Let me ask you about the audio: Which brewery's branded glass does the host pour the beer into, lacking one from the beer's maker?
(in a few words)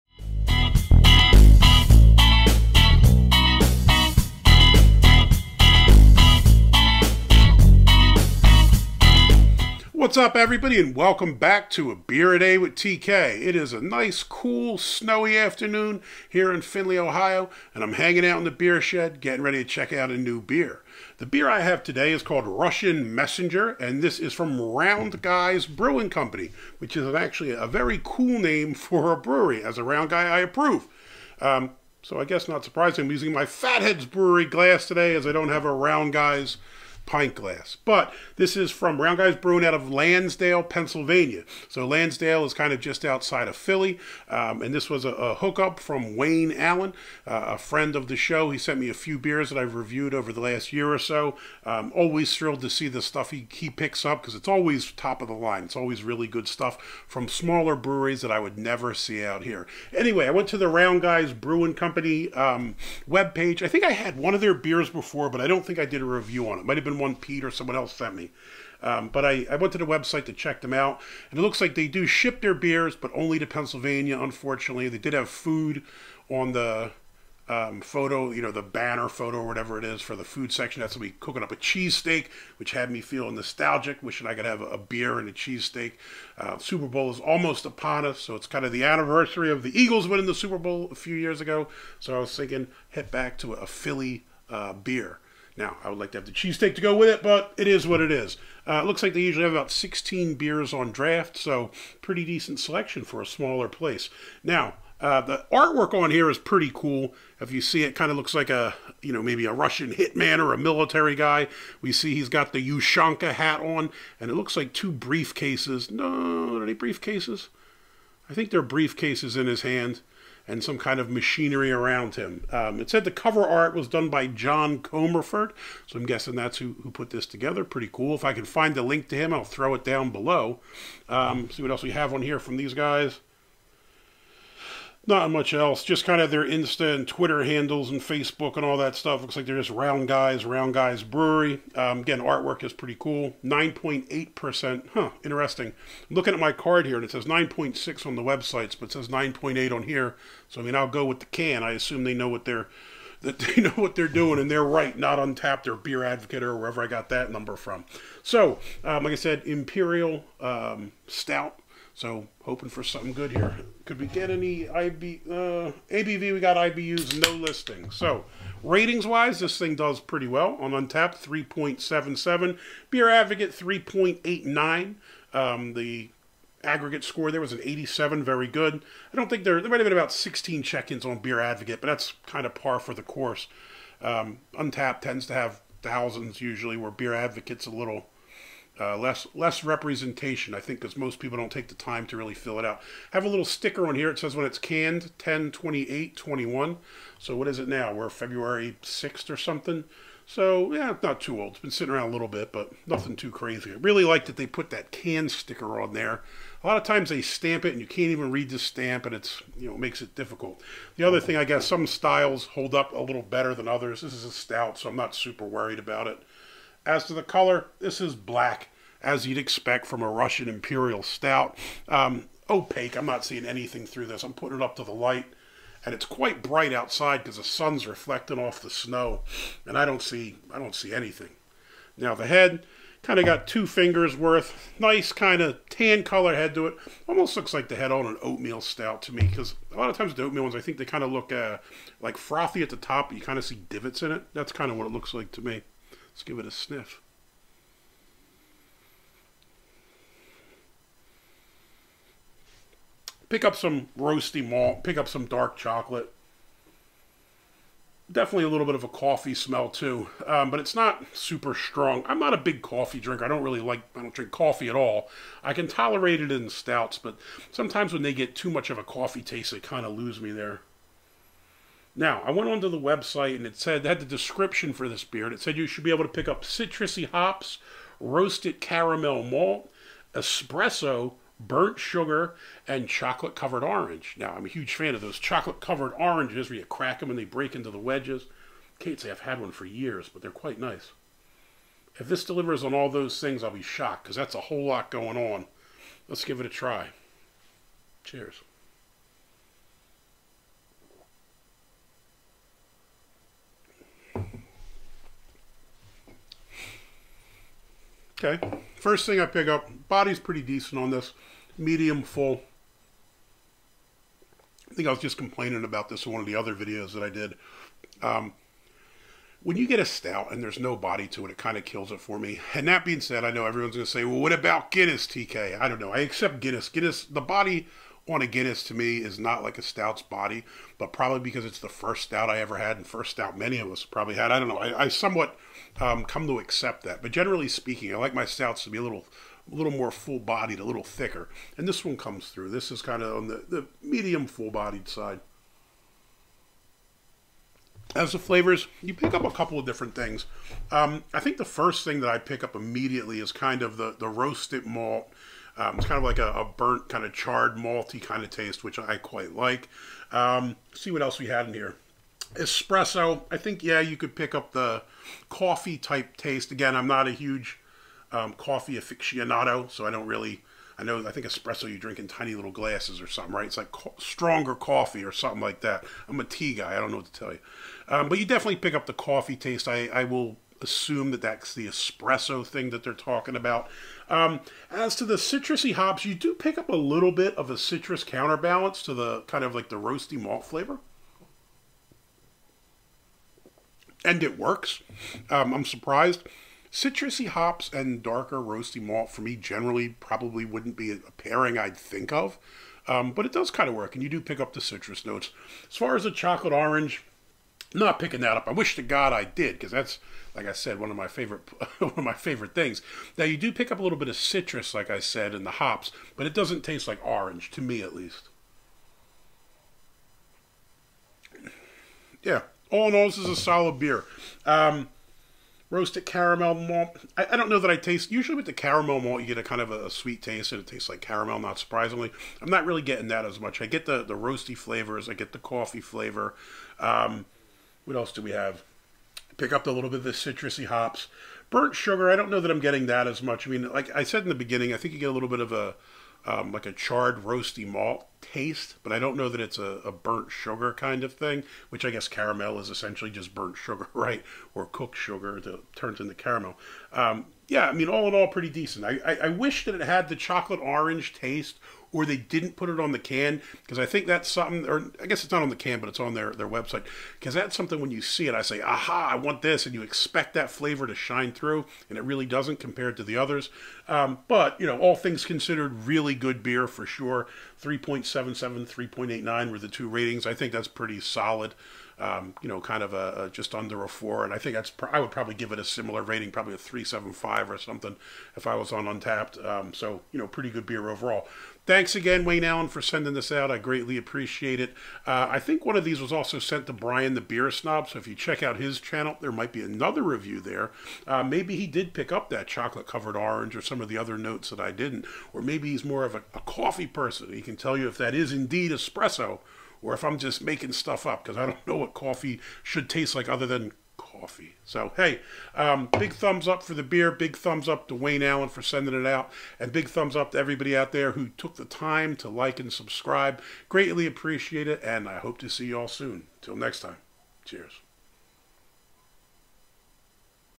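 Fat Head's Brewery.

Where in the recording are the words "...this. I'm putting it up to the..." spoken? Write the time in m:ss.
3:44.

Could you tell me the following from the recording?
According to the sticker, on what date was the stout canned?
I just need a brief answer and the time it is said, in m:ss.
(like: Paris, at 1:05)
10/28/21, at 3:15.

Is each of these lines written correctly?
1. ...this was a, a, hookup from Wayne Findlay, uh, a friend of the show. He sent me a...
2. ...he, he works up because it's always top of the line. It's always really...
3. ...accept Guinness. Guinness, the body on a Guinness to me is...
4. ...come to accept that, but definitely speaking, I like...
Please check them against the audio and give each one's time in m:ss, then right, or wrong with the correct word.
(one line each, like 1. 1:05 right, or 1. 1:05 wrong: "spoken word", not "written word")
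1. 0:44 wrong: "Allen", not "Findlay"
2. 0:53 wrong: "picks", not "works"
3. 5:26 right
4. 5:36 wrong: "generally", not "definitely".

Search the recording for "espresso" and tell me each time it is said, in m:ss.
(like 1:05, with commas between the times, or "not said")
4:40, 6:02, 6:11, 6:21, 8:28.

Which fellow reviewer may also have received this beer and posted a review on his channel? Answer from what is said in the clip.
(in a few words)
Brian the Beer Snob.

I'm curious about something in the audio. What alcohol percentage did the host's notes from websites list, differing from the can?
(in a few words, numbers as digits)
9.6%.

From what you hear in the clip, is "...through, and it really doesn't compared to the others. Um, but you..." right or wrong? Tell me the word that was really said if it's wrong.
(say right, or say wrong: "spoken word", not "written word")
right.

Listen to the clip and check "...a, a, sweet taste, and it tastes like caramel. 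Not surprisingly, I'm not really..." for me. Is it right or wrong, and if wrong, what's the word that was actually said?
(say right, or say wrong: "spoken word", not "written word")
right.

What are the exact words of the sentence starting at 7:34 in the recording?
Or cooked sugar that turns into caramel.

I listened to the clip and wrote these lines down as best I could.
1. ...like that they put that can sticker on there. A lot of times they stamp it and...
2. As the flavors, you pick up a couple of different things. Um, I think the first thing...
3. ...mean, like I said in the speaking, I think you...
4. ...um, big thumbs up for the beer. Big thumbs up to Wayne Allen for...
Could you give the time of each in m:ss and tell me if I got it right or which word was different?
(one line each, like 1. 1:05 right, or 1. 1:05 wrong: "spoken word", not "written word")
1. 3:24 right
2. 5:47 right
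3. 7:23 wrong: "beginning", not "speaking"
4. 8:35 right.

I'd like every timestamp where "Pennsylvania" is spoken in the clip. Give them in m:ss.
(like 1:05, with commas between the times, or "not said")
0:40, 1:13.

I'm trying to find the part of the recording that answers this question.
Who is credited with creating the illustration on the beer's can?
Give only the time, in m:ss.
2:04.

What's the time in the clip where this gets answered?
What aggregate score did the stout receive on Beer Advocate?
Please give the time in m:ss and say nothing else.
2:57.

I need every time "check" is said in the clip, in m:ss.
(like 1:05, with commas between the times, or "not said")
0:19, 1:10, 3:00, 8:18.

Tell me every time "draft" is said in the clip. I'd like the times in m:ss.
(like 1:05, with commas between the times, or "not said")
1:40.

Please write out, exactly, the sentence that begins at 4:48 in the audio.
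Can't say I've had one for years, but they're quite nice.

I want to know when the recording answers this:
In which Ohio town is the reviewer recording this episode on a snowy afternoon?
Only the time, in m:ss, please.
0:16.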